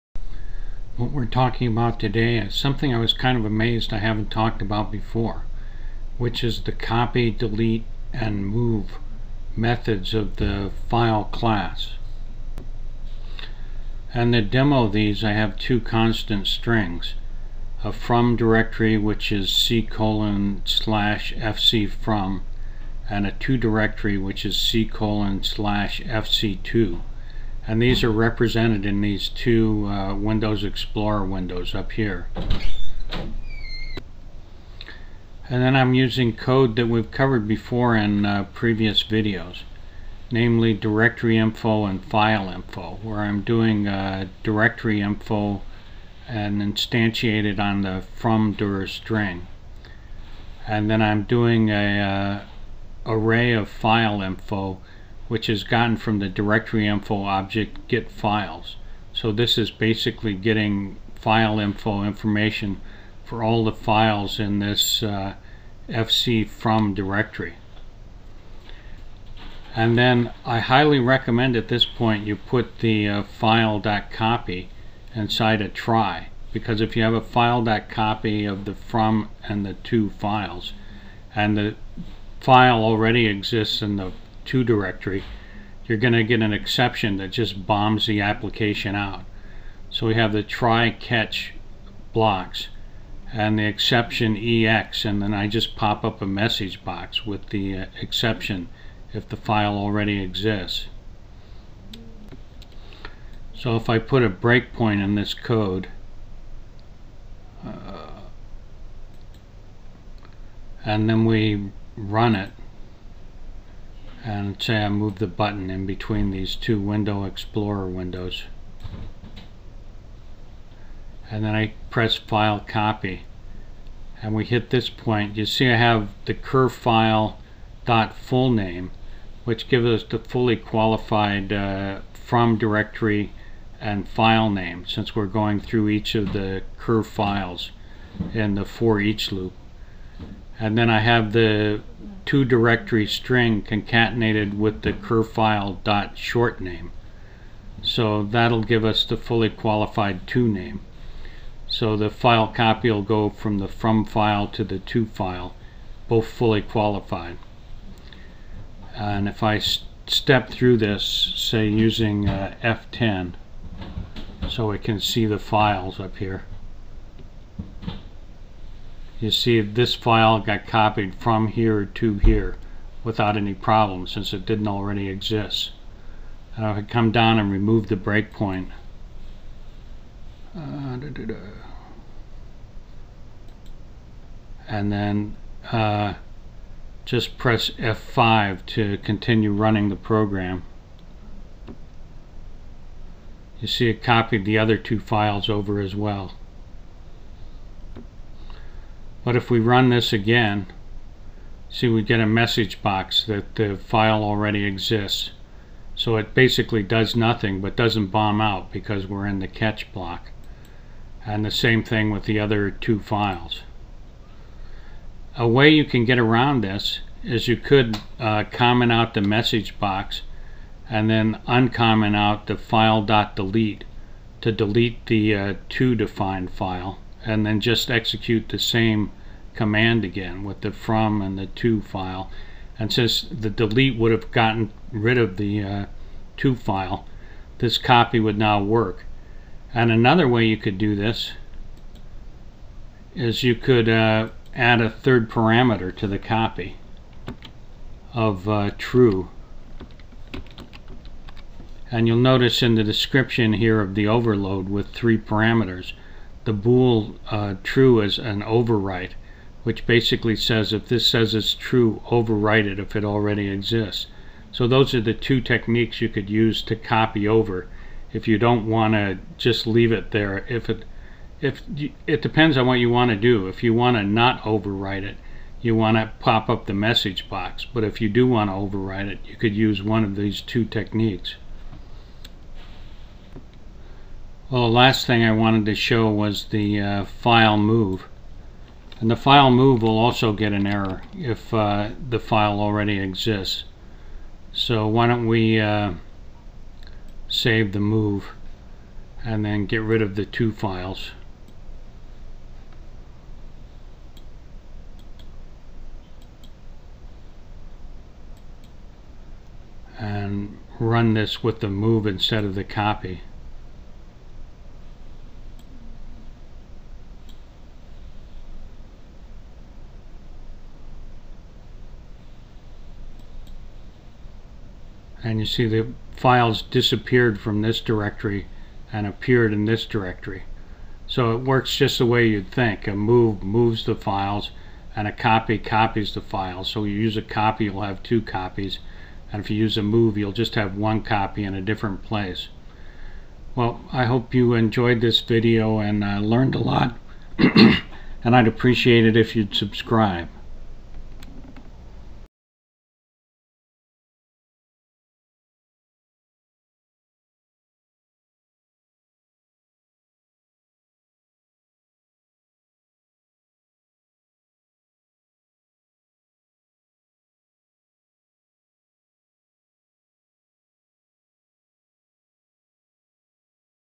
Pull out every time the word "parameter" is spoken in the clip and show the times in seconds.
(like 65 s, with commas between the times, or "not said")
245 s, 255 s.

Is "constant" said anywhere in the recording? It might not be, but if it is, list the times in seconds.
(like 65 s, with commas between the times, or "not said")
15 s.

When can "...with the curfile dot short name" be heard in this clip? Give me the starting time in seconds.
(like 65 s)
144 s.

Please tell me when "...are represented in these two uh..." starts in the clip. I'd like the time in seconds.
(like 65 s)
28 s.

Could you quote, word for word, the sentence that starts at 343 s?
Well, I hope you enjoyed this video and uh, learned a lot.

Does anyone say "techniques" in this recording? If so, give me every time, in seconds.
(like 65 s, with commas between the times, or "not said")
265 s, 280 s.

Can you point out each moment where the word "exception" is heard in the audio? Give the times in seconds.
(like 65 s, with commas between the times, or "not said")
86 s, 93 s, 98 s.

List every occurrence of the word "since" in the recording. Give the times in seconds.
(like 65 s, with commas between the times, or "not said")
134 s, 174 s, 232 s.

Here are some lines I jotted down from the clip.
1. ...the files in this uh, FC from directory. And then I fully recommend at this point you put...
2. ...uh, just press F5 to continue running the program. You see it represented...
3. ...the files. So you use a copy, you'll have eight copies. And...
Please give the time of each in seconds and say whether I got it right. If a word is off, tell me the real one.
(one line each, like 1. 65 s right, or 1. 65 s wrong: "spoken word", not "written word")
1. 63 s wrong: "highly", not "fully"
2. 185 s wrong: "copied", not "represented"
3. 336 s wrong: "two", not "eight".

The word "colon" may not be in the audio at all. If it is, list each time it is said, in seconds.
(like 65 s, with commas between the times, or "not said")
19 s, 24 s.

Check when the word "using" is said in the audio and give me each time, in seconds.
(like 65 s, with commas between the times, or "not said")
35 s, 161 s.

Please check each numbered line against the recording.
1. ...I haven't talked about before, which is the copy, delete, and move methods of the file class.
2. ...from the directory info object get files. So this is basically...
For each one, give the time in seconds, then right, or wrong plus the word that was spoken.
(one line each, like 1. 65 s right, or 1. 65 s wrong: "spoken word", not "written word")
1. 3 s right
2. 55 s right.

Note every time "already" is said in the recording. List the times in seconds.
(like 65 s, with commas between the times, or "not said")
82 s, 99 s, 174 s, 204 s, 263 s, 292 s.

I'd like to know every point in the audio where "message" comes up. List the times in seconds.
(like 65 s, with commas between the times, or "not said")
96 s, 202 s, 219 s, 276 s.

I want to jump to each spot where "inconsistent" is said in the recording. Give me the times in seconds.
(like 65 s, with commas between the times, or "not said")
not said.